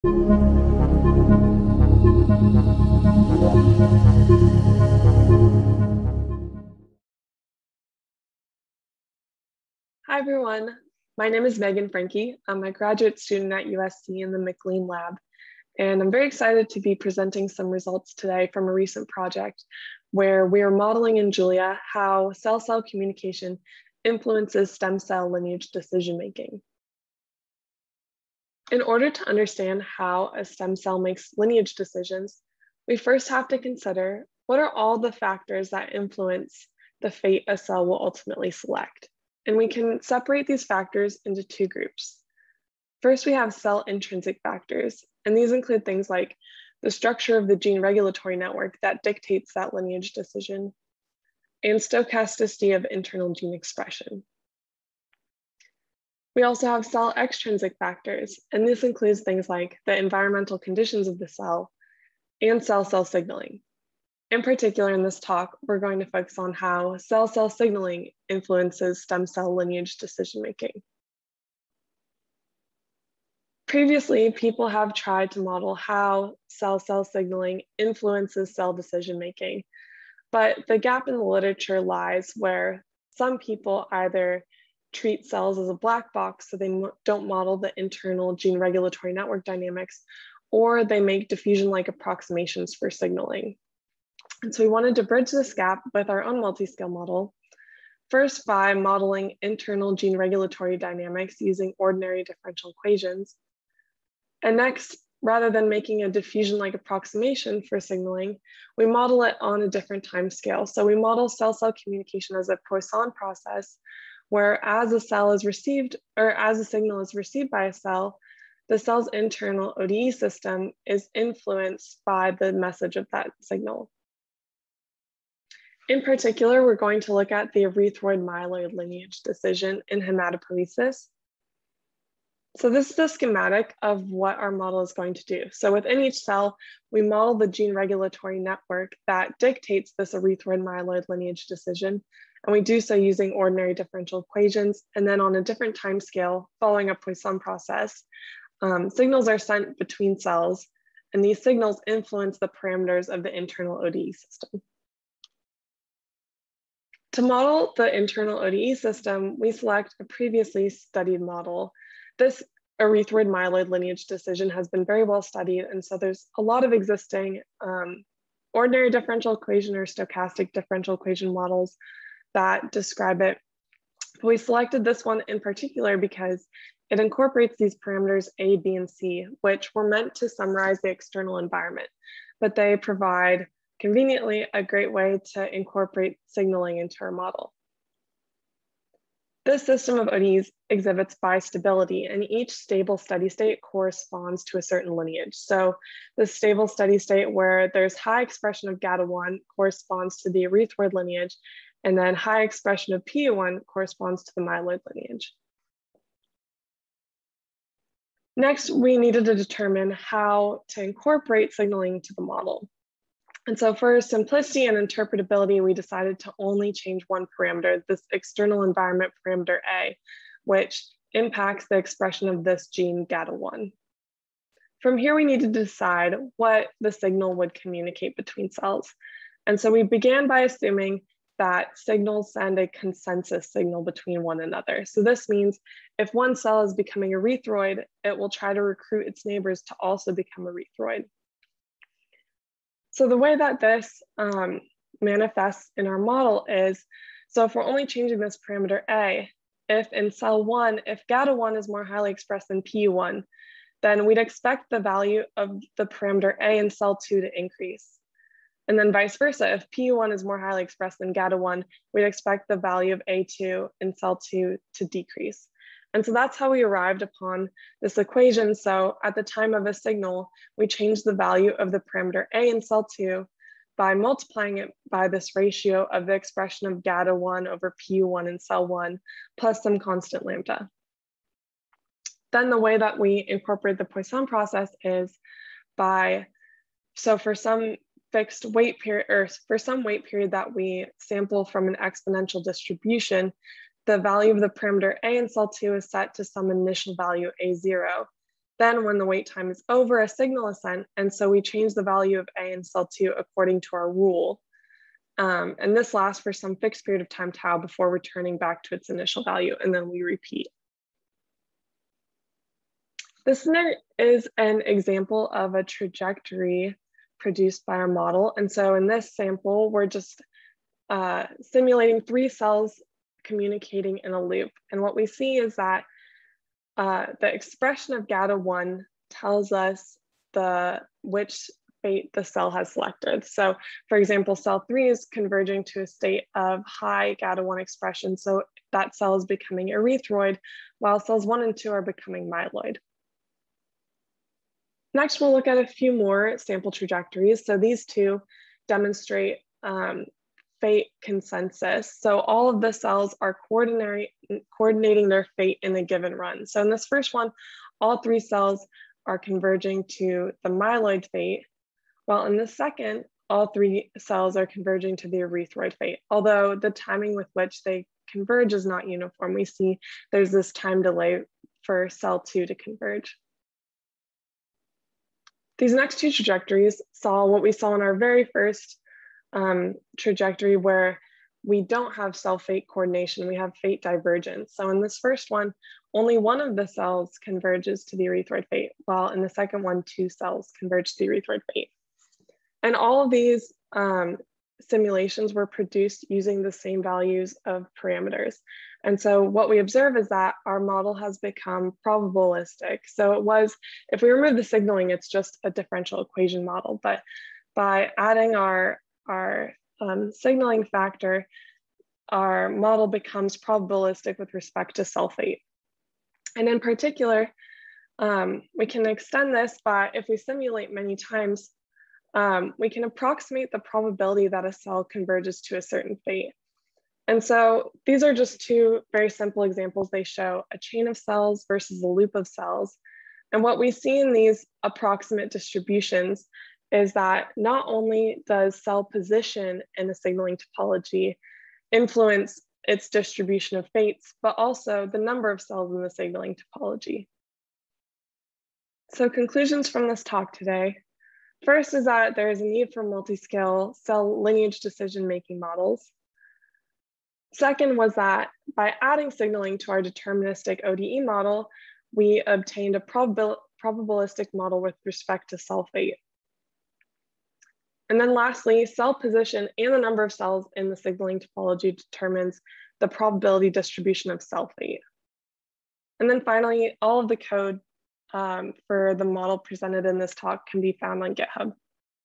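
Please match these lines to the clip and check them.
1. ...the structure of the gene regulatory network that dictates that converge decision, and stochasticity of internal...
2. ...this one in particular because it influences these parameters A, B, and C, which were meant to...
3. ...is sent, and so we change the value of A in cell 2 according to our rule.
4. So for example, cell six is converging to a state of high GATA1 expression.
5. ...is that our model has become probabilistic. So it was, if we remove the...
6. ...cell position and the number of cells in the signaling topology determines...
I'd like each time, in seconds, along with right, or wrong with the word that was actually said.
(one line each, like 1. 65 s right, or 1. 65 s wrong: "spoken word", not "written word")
1. 46 s wrong: "lineage", not "converge"
2. 174 s wrong: "incorporates", not "influences"
3. 300 s right
4. 333 s wrong: "three", not "six"
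5. 399 s right
6. 468 s right.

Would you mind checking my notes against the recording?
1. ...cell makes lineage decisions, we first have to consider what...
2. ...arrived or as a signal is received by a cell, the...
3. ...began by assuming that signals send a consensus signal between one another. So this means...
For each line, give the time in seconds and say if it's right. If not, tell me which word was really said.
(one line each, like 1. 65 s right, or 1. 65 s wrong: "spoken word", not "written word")
1. 30 s right
2. 115 s wrong: "received", not "arrived"
3. 229 s right.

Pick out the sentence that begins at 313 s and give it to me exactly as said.
This is an example of a trajectory produced by our model.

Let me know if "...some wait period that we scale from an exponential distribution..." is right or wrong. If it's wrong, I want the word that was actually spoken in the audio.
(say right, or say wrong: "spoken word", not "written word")
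wrong: "sample", not "scale".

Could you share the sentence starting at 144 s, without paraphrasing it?
And then on a different time scale, following a Poisson process, um, signals are sent between cells.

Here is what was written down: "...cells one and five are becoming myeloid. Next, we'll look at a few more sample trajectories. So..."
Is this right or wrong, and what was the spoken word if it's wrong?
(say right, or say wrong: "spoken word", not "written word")
wrong: "two", not "five".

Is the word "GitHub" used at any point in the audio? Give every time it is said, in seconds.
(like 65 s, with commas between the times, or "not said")
481 s.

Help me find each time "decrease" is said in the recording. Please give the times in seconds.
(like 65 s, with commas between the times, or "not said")
264 s.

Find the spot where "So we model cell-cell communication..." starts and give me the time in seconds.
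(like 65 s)
110 s.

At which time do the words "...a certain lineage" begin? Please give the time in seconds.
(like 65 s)
194 s.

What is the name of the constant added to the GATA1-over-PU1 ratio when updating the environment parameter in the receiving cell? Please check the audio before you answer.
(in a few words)
lambda.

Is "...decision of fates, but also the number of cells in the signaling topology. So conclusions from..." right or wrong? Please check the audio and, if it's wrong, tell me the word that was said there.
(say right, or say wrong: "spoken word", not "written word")
wrong: "distribution", not "decision".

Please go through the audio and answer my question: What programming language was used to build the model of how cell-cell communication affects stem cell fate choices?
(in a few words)
Julia.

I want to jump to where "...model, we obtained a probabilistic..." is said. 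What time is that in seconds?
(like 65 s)
461 s.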